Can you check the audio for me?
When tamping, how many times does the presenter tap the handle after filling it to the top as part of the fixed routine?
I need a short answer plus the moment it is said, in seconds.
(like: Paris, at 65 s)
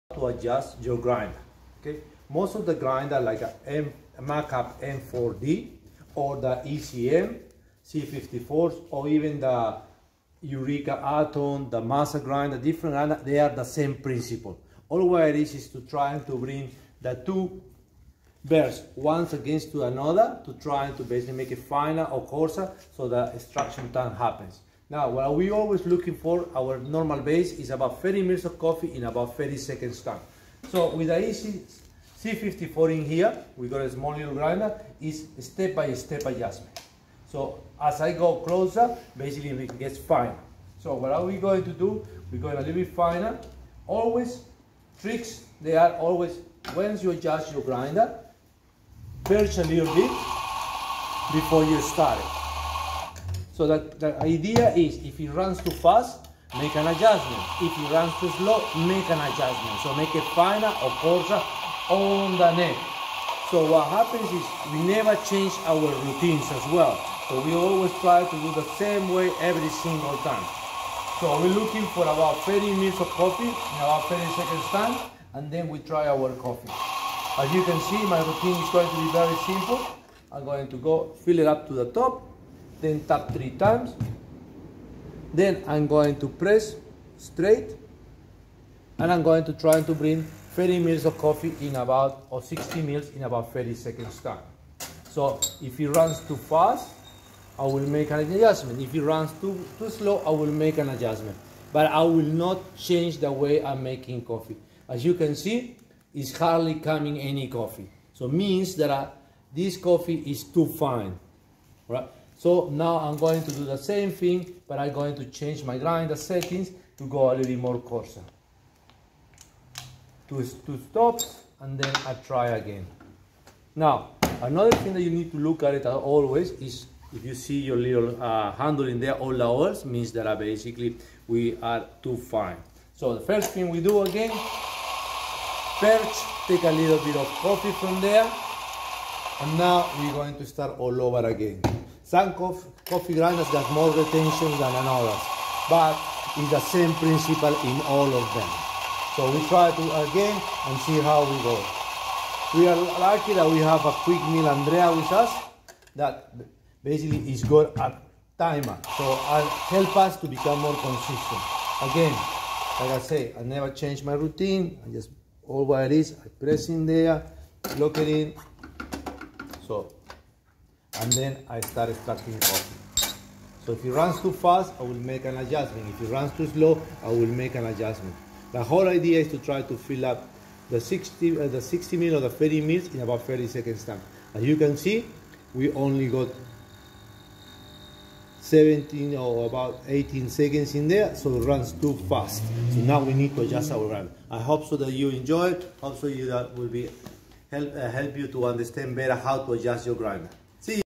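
3, at 83 s.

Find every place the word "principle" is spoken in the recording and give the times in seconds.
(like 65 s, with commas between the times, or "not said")
13 s, 146 s.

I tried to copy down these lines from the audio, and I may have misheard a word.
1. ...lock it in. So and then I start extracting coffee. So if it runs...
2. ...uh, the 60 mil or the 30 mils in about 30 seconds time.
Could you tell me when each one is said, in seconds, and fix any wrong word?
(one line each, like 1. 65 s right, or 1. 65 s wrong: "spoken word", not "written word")
1. 167 s right
2. 181 s right.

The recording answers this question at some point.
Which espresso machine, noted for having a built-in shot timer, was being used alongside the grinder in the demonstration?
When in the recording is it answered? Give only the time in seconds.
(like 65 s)
154 s.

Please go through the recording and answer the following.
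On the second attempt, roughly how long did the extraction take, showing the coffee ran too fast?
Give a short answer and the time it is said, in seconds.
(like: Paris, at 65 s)
17 seconds, at 188 s.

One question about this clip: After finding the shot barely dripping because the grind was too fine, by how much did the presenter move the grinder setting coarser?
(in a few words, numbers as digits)
2 stops.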